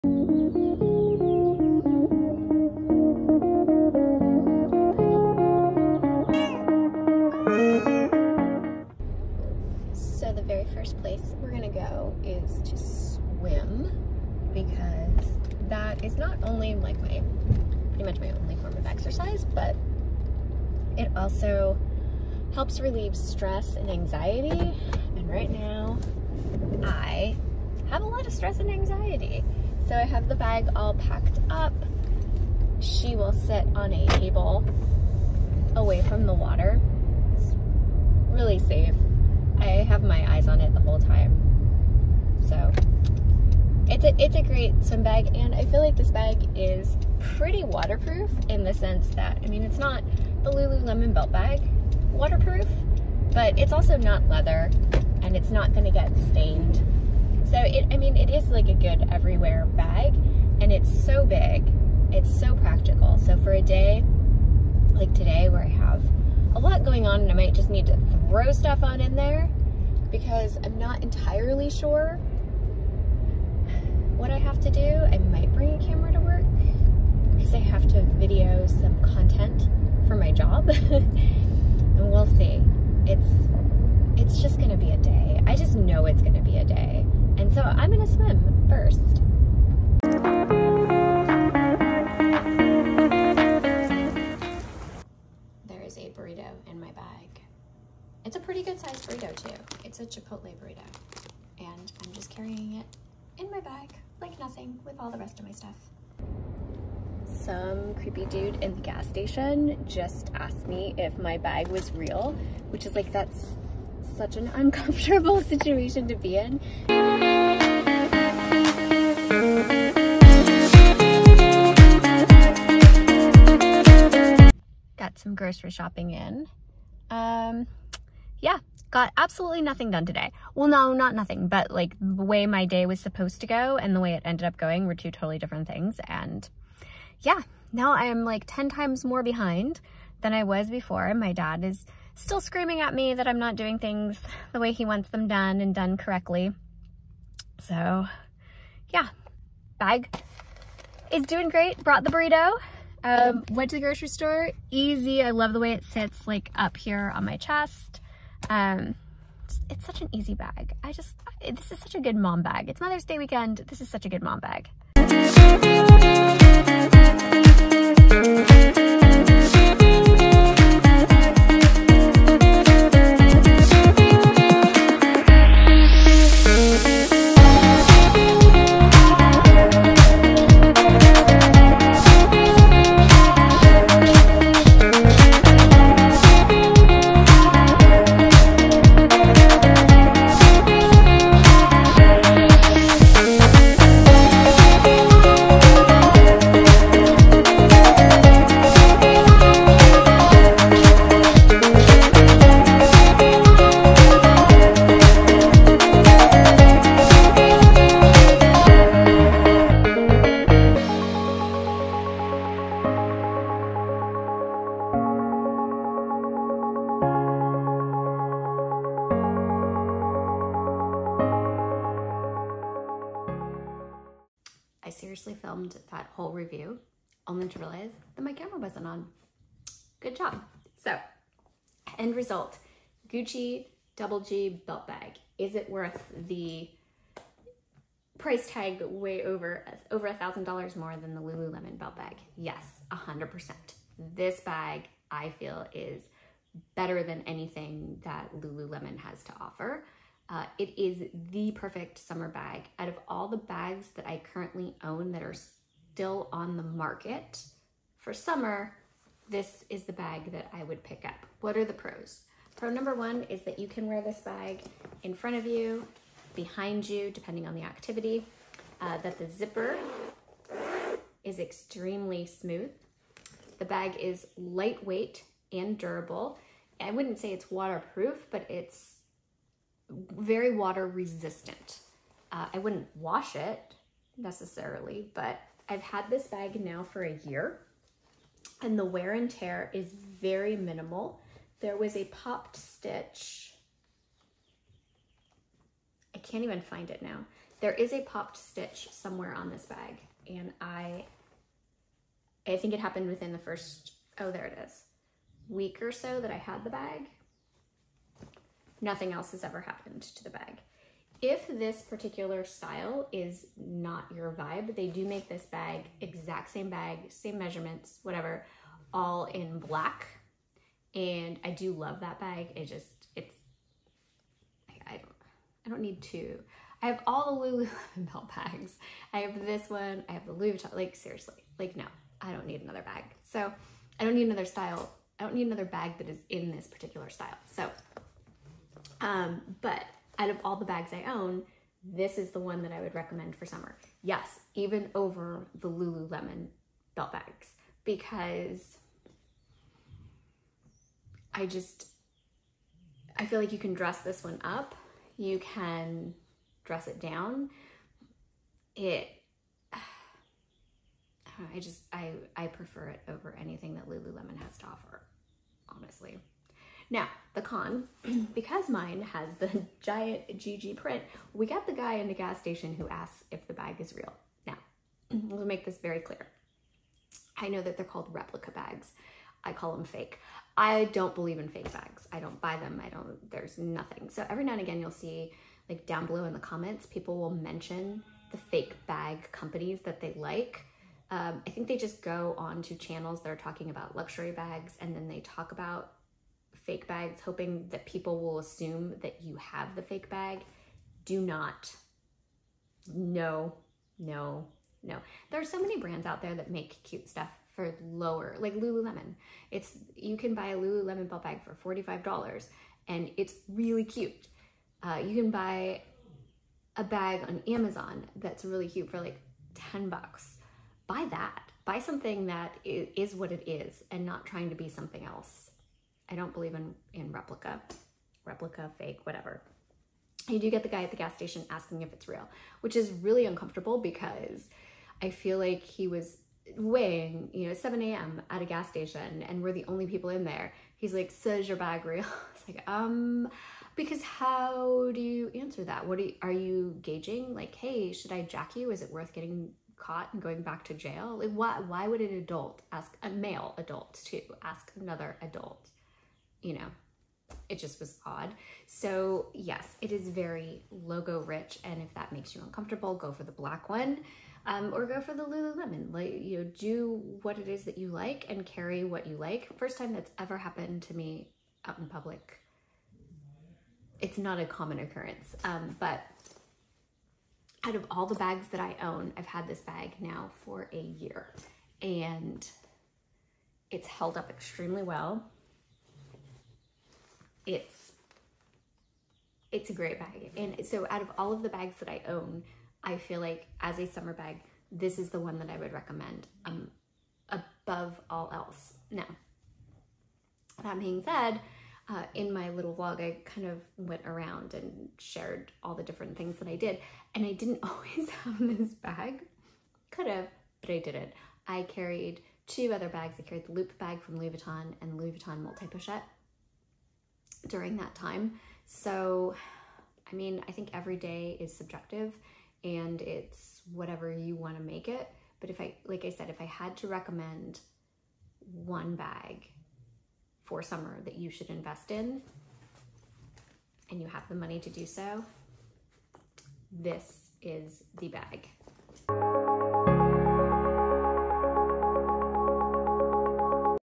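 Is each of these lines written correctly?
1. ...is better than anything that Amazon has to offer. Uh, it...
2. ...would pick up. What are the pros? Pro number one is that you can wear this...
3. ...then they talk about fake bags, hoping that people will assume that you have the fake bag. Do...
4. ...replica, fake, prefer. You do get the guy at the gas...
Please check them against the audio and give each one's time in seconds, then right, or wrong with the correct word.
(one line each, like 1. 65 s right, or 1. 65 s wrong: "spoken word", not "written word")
1. 245 s wrong: "Lululemon", not "Amazon"
2. 260 s right
3. 394 s right
4. 428 s wrong: "whatever", not "prefer".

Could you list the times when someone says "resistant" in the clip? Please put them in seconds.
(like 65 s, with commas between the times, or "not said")
280 s.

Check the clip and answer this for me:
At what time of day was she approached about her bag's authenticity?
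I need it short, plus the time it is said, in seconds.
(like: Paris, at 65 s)
7 a.m., at 437 s.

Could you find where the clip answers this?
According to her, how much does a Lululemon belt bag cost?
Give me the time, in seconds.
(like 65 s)
411 s.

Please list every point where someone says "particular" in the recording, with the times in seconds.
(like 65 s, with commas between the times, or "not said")
311 s, 336 s.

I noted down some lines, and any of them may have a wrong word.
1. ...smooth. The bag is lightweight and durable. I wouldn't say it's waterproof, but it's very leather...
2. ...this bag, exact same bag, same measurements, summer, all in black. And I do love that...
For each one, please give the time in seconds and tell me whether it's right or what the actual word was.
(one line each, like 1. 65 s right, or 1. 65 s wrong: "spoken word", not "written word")
1. 272 s wrong: "water", not "leather"
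2. 315 s wrong: "whatever", not "summer".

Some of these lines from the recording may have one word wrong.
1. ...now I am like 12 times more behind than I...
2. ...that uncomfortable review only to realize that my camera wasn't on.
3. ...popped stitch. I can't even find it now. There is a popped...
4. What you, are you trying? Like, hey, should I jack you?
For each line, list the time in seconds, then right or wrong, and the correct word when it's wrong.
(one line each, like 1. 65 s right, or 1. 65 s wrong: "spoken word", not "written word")
1. 137 s wrong: "10", not "12"
2. 225 s wrong: "whole", not "uncomfortable"
3. 292 s right
4. 445 s wrong: "gauging", not "trying".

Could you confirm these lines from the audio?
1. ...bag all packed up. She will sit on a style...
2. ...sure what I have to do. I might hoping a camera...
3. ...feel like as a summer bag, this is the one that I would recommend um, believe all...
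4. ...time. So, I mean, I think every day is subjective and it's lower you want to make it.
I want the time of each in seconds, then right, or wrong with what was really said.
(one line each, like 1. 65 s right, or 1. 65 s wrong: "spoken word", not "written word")
1. 30 s wrong: "table", not "style"
2. 71 s wrong: "bring", not "hoping"
3. 492 s wrong: "above", not "believe"
4. 517 s wrong: "whatever", not "lower".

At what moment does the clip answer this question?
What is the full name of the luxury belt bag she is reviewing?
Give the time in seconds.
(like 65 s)
233 s.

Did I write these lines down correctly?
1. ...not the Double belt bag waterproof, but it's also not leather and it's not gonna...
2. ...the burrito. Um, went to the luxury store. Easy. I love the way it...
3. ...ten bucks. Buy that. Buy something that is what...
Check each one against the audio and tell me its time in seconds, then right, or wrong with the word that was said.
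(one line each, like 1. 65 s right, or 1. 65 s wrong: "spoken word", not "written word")
1. 49 s wrong: "Lululemon", not "Double"
2. 152 s wrong: "grocery", not "luxury"
3. 419 s right.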